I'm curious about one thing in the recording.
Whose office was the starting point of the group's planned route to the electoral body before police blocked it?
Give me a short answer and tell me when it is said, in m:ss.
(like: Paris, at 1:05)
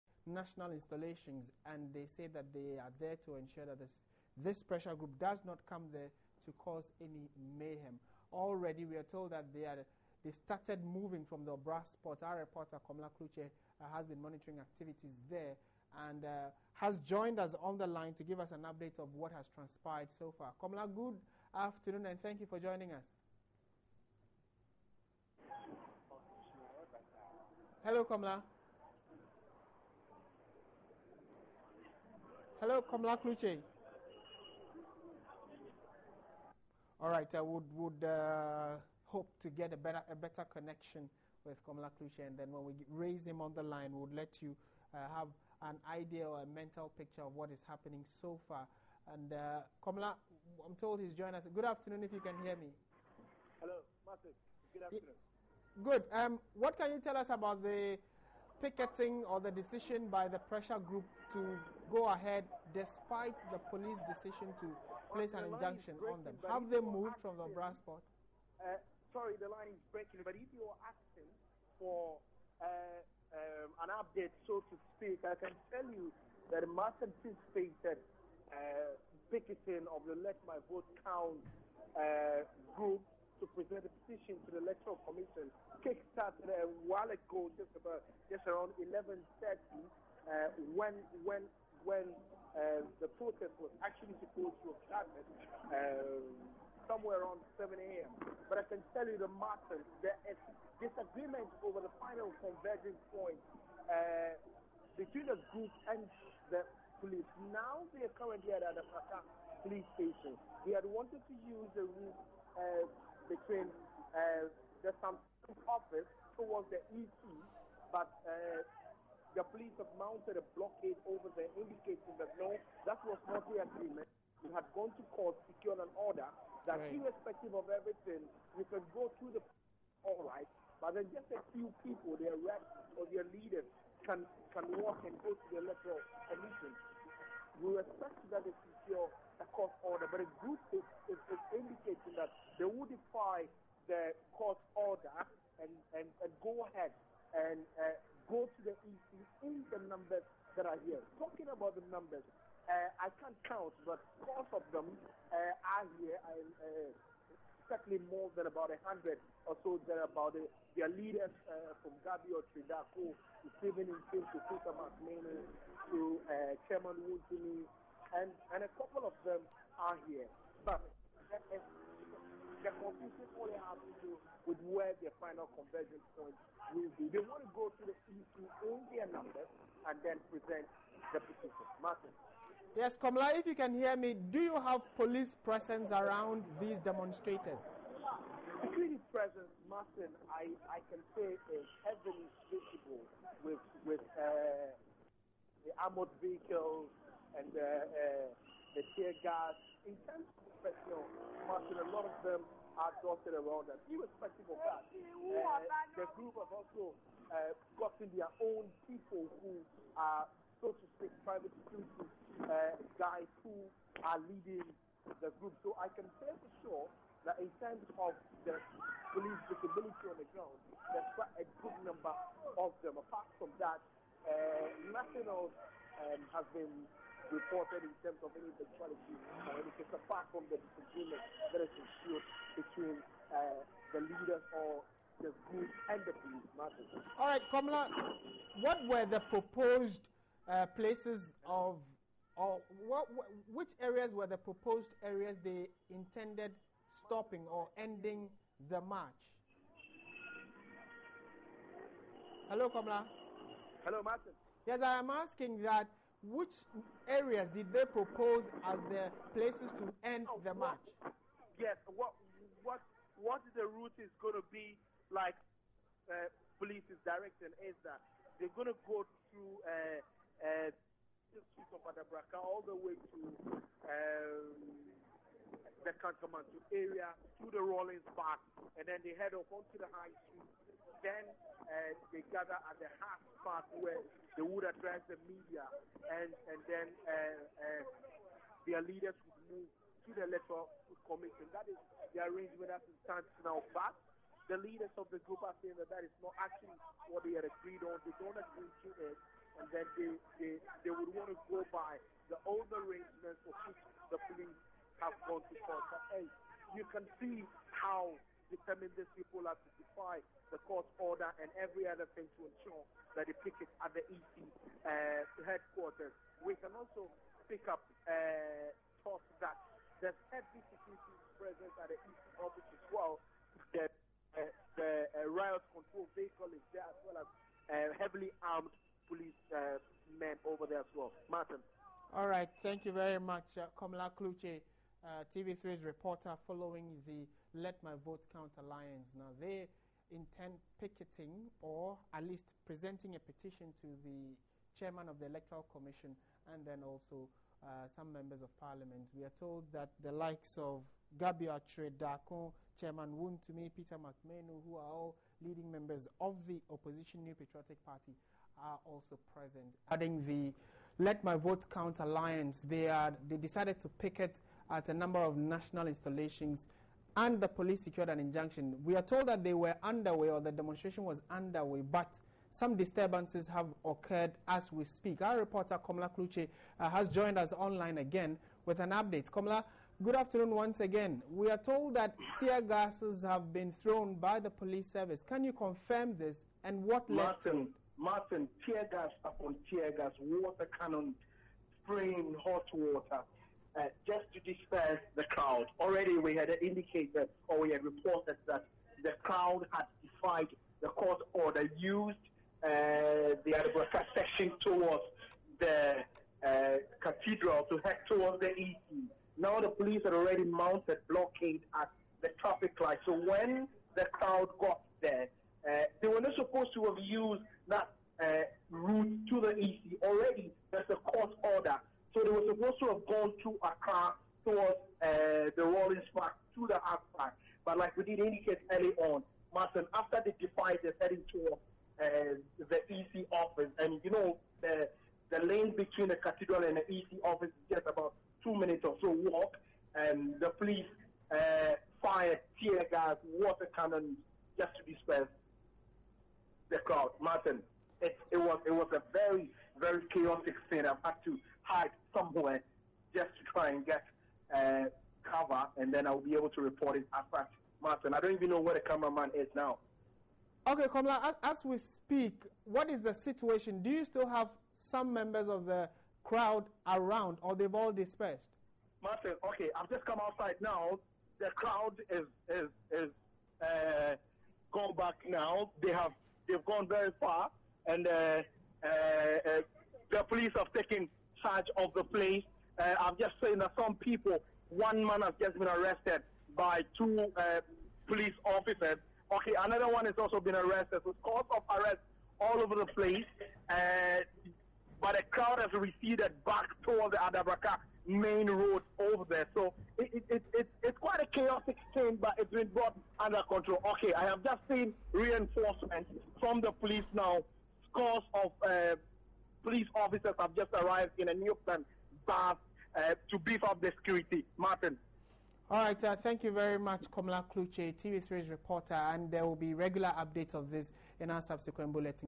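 Samsung, at 1:55.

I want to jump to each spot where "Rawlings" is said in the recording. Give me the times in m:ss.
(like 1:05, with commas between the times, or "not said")
4:37, 7:05.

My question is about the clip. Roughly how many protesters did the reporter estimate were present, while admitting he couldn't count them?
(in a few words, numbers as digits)
about 100.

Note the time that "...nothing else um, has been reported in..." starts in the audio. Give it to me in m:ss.
3:44.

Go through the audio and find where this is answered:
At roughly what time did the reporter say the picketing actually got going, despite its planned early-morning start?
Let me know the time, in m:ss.
1:28.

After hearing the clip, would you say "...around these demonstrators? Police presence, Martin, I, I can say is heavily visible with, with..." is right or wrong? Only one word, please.
right.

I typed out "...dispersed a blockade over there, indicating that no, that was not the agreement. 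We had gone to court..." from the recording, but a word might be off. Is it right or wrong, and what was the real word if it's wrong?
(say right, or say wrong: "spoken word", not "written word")
wrong: "mounted", not "dispersed".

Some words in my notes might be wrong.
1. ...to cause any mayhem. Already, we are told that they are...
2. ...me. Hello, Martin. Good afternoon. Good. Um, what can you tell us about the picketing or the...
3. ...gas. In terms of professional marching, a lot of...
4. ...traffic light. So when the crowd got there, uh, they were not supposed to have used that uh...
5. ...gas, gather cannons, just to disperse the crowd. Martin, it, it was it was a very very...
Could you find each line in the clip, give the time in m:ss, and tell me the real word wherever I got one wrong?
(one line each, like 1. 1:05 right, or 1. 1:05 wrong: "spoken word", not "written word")
1. 0:06 right
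2. 0:52 right
3. 3:19 right
4. 6:52 right
5. 7:22 wrong: "water", not "gather".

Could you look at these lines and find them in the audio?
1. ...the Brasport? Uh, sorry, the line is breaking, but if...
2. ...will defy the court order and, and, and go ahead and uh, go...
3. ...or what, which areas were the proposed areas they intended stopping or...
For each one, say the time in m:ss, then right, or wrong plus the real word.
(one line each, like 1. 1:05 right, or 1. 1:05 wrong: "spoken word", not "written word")
1. 1:07 right
2. 2:22 right
3. 4:02 right.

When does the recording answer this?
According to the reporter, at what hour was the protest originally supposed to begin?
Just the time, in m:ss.
1:37.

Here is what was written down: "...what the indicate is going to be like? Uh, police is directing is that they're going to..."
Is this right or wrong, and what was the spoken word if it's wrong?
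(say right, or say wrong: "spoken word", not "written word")
wrong: "route", not "indicate".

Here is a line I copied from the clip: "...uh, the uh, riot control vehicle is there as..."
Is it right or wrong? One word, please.
right.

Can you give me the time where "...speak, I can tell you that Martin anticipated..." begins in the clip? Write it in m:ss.
1:14.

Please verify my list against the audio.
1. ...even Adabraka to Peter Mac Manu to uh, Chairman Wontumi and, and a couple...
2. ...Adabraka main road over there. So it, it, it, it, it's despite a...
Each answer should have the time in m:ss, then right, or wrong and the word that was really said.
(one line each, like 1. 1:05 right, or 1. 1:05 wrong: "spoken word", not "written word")
1. 2:43 wrong: "Nkim", not "Adabraka"
2. 8:17 wrong: "quite", not "despite".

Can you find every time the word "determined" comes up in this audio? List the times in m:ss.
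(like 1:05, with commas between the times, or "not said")
5:08.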